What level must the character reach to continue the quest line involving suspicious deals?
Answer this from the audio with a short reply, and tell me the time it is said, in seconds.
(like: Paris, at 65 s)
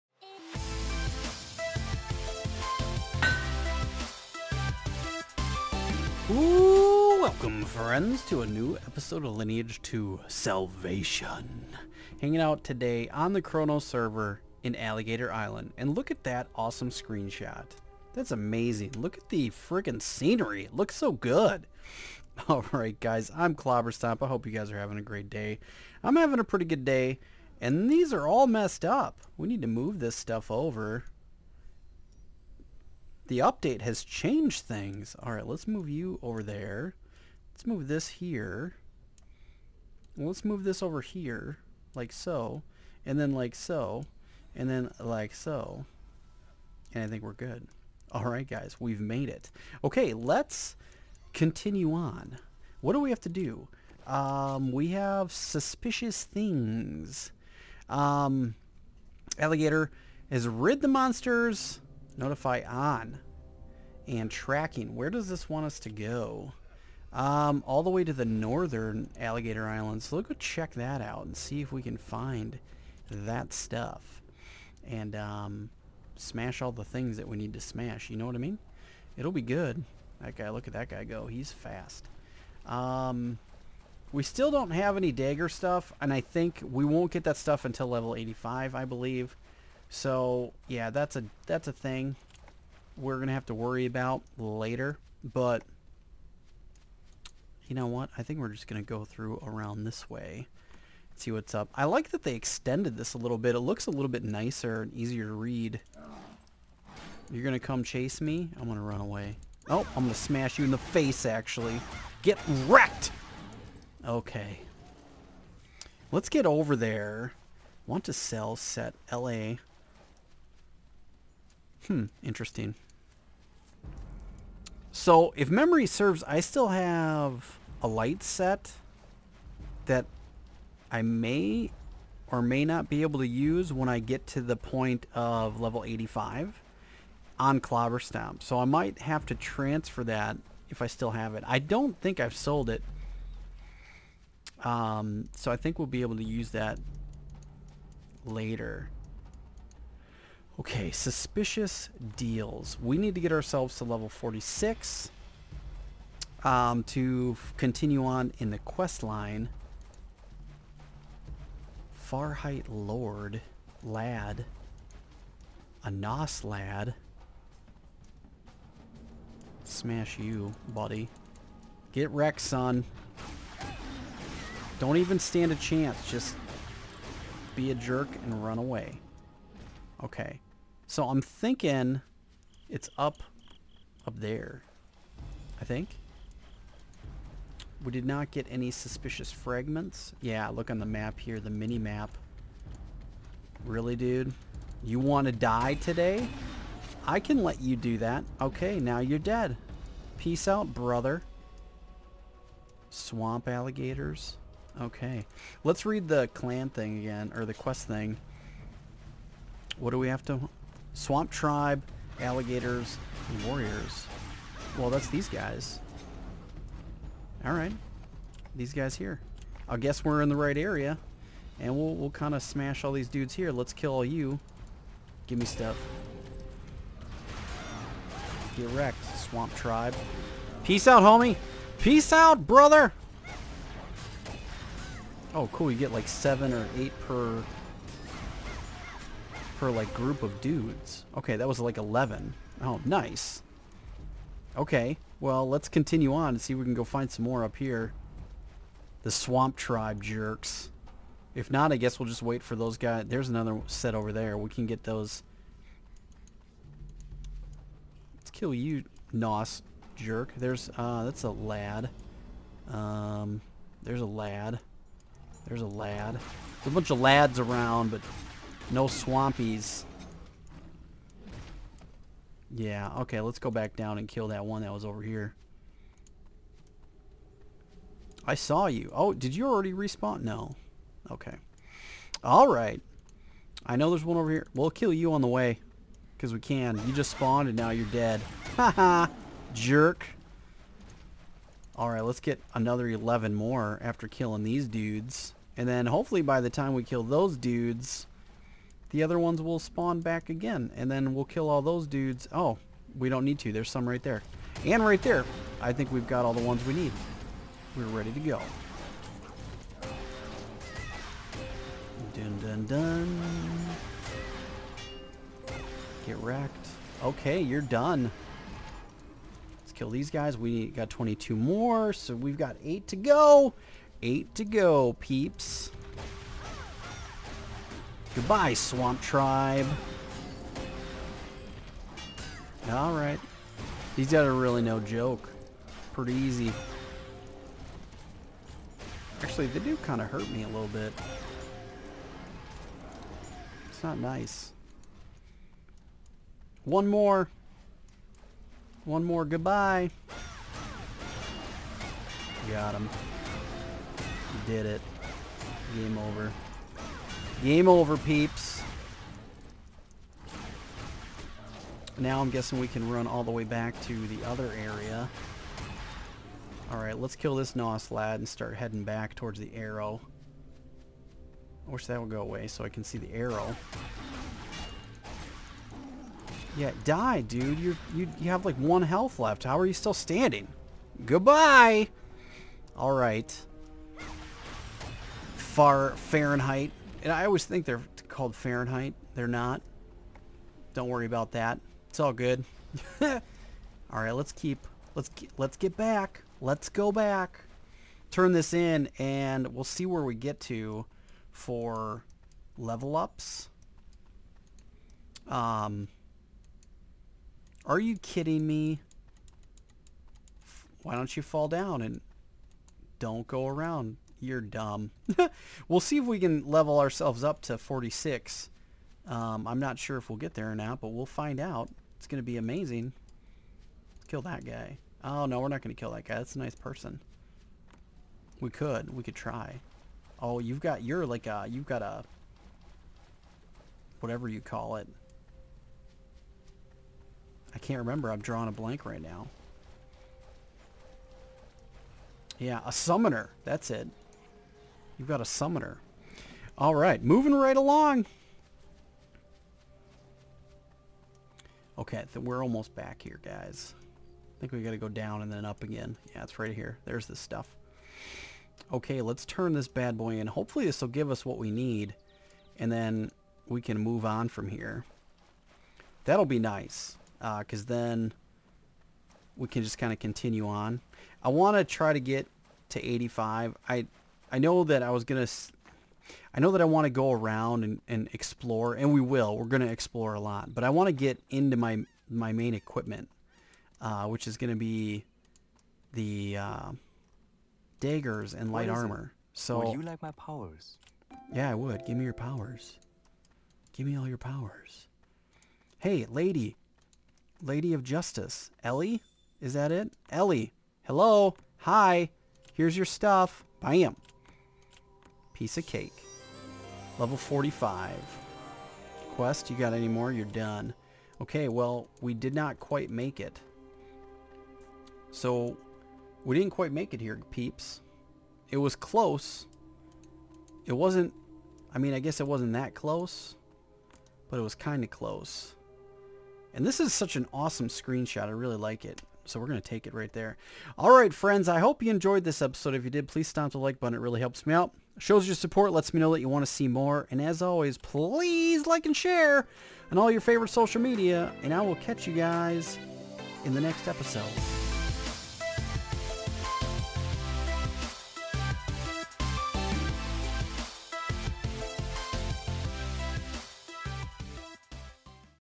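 46, at 153 s.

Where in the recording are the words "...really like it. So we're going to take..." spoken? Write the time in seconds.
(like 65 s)
528 s.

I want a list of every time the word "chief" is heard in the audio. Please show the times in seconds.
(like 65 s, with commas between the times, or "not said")
not said.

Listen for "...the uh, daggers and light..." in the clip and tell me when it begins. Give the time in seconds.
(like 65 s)
485 s.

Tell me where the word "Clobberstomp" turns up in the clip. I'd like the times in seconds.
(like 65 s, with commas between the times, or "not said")
23 s, 137 s.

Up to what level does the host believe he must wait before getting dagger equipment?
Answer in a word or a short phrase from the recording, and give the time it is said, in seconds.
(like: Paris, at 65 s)
85, at 87 s.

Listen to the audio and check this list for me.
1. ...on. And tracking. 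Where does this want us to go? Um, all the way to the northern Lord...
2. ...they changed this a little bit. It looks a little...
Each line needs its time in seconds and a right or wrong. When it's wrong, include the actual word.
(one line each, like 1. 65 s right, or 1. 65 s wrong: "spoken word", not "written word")
1. 62 s wrong: "Alligator", not "Lord"
2. 102 s wrong: "extended", not "changed".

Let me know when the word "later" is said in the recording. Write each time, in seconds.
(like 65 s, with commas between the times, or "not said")
94 s, 148 s.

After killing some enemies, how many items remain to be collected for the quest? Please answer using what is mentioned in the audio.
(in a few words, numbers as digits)
8.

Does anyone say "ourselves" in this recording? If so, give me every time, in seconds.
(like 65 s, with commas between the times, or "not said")
153 s, 416 s.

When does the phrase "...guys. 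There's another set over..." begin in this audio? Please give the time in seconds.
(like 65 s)
252 s.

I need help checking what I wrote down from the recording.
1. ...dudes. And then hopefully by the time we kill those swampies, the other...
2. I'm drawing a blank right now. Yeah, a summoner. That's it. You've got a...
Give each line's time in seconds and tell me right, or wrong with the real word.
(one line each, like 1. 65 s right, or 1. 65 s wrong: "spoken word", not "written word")
1. 294 s wrong: "dudes", not "swampies"
2. 438 s right.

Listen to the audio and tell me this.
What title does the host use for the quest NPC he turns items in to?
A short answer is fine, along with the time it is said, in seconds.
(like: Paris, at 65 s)
Lady of Justice, at 497 s.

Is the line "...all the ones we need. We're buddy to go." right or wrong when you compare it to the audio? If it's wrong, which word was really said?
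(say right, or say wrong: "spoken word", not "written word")
wrong: "ready", not "buddy".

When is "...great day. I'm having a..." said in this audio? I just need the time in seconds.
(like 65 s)
25 s.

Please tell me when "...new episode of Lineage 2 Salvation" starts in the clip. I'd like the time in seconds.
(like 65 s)
8 s.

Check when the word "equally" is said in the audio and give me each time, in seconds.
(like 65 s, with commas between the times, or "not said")
not said.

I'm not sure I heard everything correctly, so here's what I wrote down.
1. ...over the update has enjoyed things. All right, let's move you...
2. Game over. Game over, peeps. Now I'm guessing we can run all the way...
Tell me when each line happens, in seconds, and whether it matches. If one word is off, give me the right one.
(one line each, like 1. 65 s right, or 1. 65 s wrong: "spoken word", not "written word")
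1. 30 s wrong: "changed", not "enjoyed"
2. 355 s right.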